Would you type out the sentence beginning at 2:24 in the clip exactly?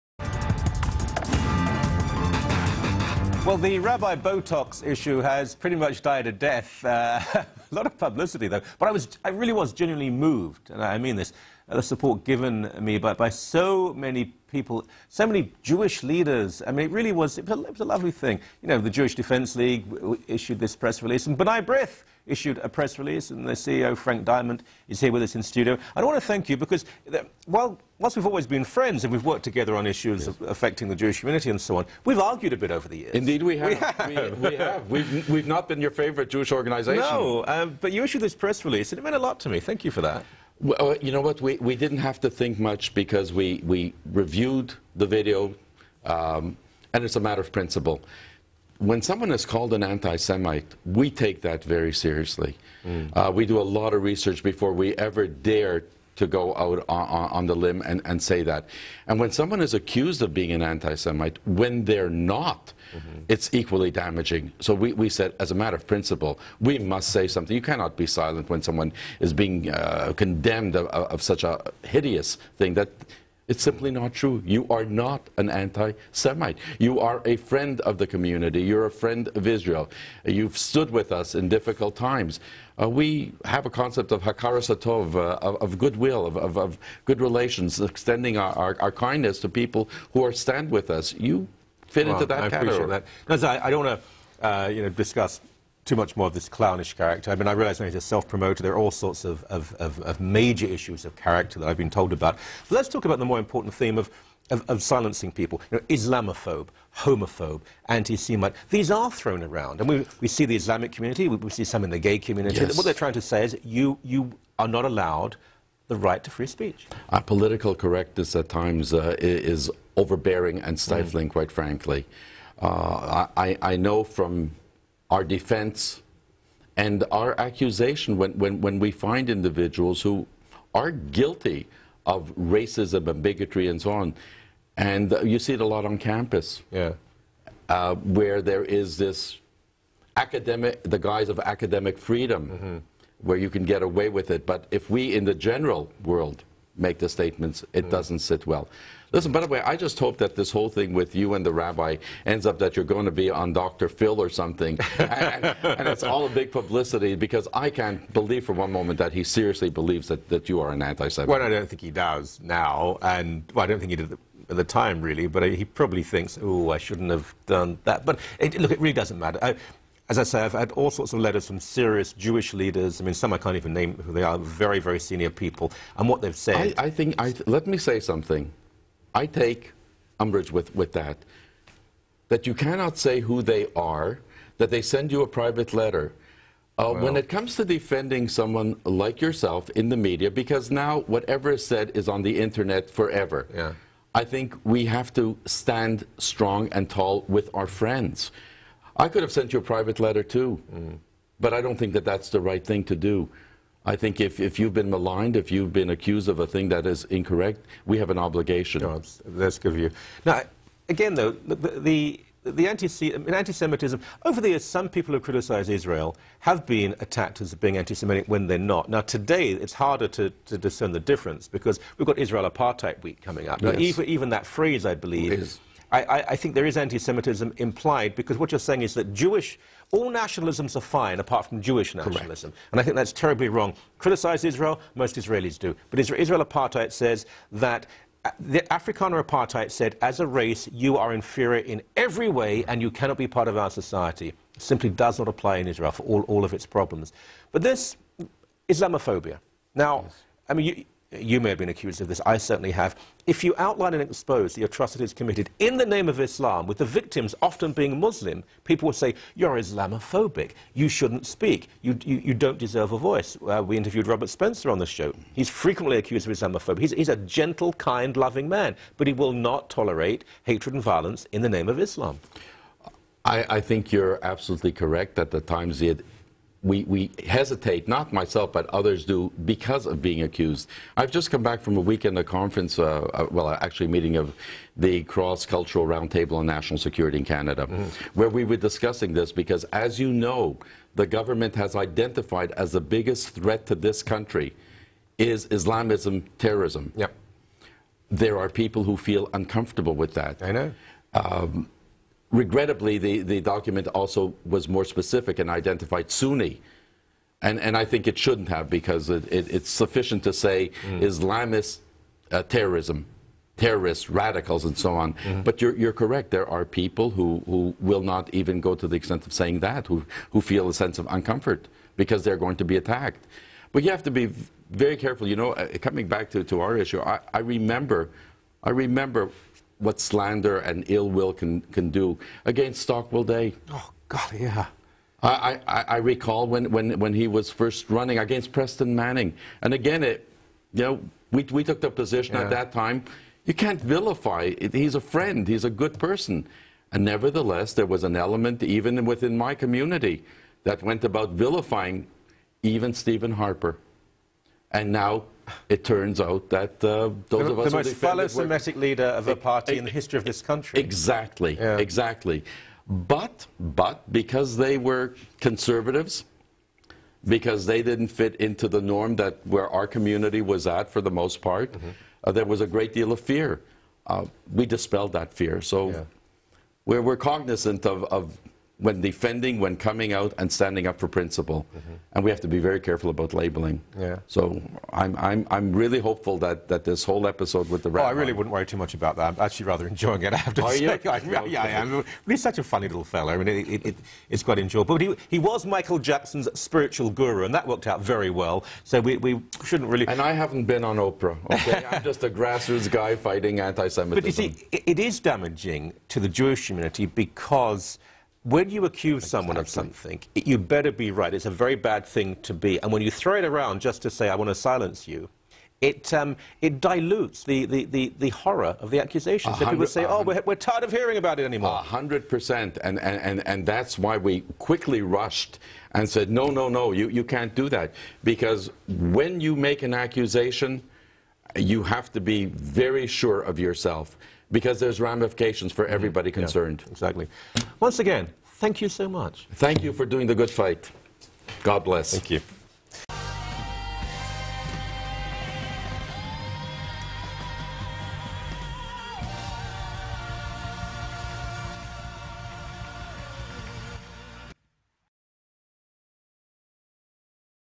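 But if we in the general world make the statements, it mm.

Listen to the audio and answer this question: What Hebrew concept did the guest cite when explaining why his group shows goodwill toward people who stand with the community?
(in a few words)
hakaras hatov.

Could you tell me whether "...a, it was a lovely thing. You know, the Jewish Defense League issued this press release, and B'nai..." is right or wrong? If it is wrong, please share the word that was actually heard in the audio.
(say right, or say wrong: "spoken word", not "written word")
right.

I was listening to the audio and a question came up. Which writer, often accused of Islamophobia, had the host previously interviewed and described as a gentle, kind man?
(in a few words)
Robert Spencer.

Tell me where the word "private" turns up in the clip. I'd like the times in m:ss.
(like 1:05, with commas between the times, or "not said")
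3:05, 3:19.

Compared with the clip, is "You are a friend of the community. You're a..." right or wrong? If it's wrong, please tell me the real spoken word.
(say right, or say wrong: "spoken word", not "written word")
right.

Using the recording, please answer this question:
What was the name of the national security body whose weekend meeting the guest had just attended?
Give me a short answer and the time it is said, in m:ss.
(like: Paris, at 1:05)
Cross Cultural Roundtable on National Security, at 4:45.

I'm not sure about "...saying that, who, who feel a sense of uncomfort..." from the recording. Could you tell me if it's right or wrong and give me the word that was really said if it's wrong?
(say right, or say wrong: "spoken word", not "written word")
right.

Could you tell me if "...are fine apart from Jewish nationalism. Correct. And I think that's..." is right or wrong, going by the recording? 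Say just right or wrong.
right.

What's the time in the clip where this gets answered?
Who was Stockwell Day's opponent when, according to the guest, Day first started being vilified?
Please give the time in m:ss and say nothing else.
5:38.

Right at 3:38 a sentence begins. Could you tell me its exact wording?
Now, today, it's harder to, to discern the difference because we've got Israel Apartheid Week coming up.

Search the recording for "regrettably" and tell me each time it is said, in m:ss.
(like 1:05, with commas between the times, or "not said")
5:02.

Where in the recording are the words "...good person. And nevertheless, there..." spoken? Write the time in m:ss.
5:45.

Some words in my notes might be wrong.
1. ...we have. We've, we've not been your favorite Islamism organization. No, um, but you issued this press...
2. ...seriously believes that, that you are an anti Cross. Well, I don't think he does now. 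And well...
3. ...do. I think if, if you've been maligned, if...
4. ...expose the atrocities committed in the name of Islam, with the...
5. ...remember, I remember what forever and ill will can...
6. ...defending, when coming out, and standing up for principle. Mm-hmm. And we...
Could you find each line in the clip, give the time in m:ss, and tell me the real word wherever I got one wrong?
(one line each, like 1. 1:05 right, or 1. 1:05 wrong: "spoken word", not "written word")
1. 0:34 wrong: "Jewish", not "Islamism"
2. 2:39 wrong: "Semite", not "Cross"
3. 3:22 right
4. 4:14 right
5. 5:27 wrong: "slander", not "forever"
6. 6:18 right.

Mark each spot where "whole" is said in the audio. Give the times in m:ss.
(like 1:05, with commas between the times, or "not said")
2:30, 6:27.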